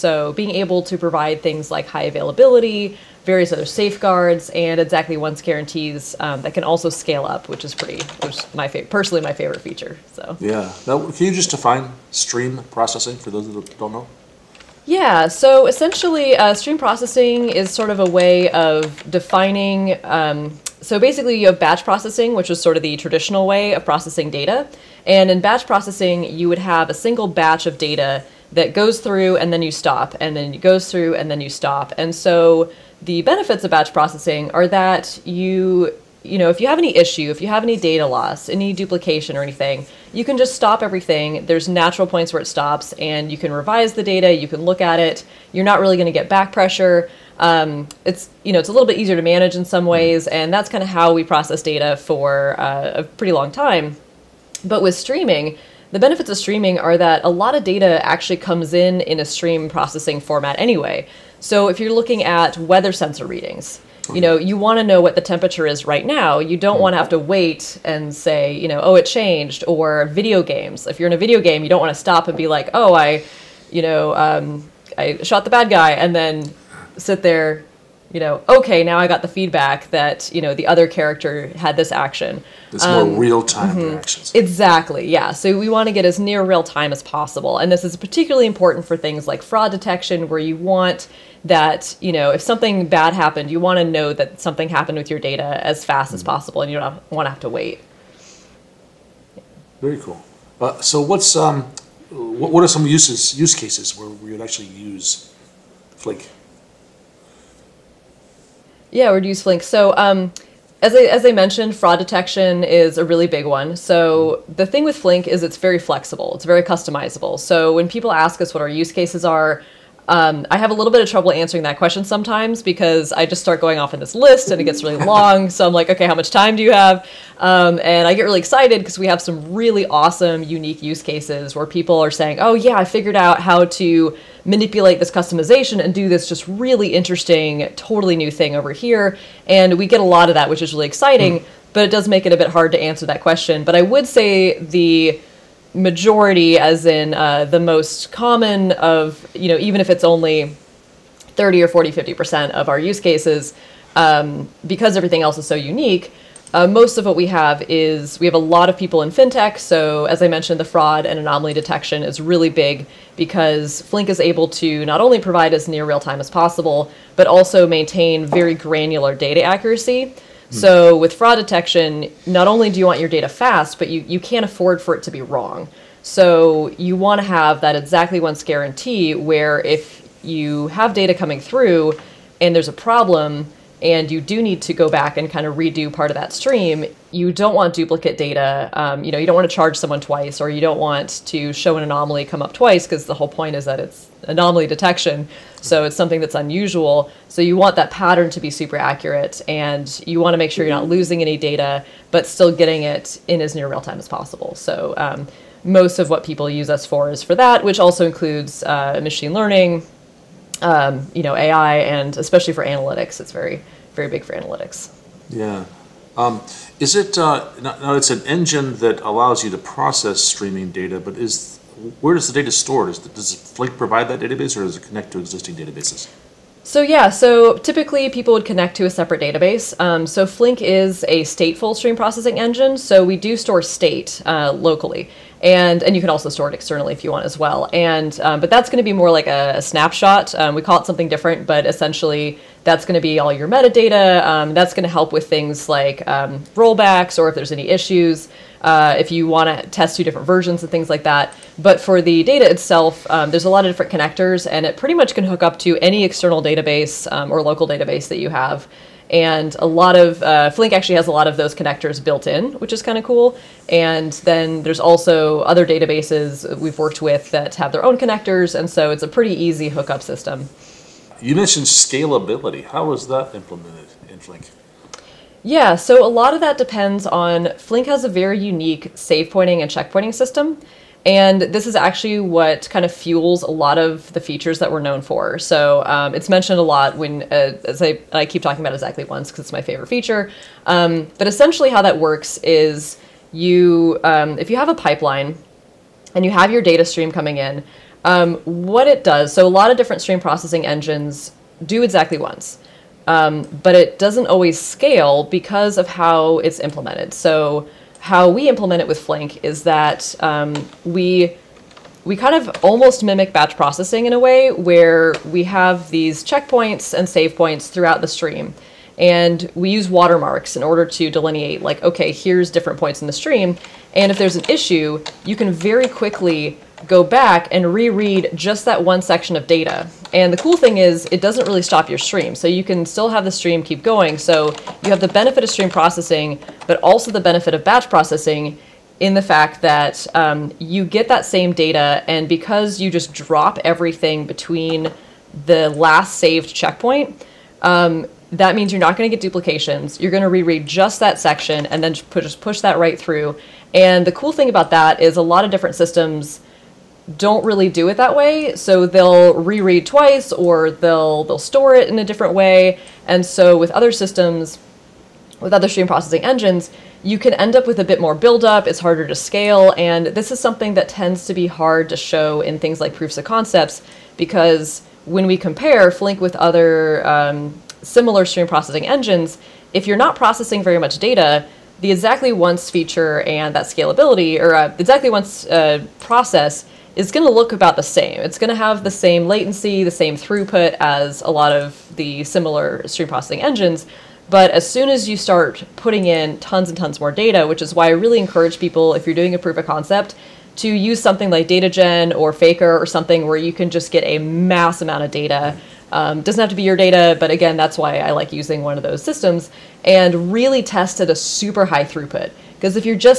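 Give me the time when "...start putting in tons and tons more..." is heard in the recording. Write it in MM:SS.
06:35.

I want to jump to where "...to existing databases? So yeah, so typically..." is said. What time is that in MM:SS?
03:45.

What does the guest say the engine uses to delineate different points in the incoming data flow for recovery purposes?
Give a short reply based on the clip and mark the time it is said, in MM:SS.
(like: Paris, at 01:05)
Watermarks, at 05:19.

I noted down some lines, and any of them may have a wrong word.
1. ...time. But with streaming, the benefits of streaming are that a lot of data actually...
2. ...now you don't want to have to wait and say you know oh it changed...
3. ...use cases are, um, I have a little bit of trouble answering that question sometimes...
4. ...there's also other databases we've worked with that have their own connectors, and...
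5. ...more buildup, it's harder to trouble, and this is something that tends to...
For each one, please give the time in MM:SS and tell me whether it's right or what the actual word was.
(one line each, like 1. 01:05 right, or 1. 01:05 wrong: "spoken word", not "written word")
1. 00:53 right
2. 01:06 right
3. 01:58 right
4. 04:24 right
5. 06:08 wrong: "scale", not "trouble".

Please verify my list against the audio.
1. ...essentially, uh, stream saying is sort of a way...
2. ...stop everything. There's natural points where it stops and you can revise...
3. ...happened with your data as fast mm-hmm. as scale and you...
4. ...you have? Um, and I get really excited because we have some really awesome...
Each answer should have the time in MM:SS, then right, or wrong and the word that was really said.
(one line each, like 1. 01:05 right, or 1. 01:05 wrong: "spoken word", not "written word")
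1. 00:15 wrong: "processing", not "saying"
2. 00:40 right
3. 01:34 wrong: "possible", not "scale"
4. 02:06 right.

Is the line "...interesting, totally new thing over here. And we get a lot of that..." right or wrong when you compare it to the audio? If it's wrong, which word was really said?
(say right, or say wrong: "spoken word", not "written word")
right.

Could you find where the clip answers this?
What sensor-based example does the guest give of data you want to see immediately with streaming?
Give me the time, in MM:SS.
01:02.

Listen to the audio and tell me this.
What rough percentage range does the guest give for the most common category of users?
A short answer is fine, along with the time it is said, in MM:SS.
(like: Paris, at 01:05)
30 or 40, 50%, at 02:31.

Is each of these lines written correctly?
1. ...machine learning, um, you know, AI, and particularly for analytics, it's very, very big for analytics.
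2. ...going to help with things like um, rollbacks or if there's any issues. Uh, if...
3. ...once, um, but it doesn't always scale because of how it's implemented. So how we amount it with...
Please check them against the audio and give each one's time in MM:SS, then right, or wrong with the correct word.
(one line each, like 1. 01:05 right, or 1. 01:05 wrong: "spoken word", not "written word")
1. 03:29 wrong: "especially", not "particularly"
2. 04:04 right
3. 05:02 wrong: "implement", not "amount".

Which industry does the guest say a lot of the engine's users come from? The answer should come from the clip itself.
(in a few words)
Fintech.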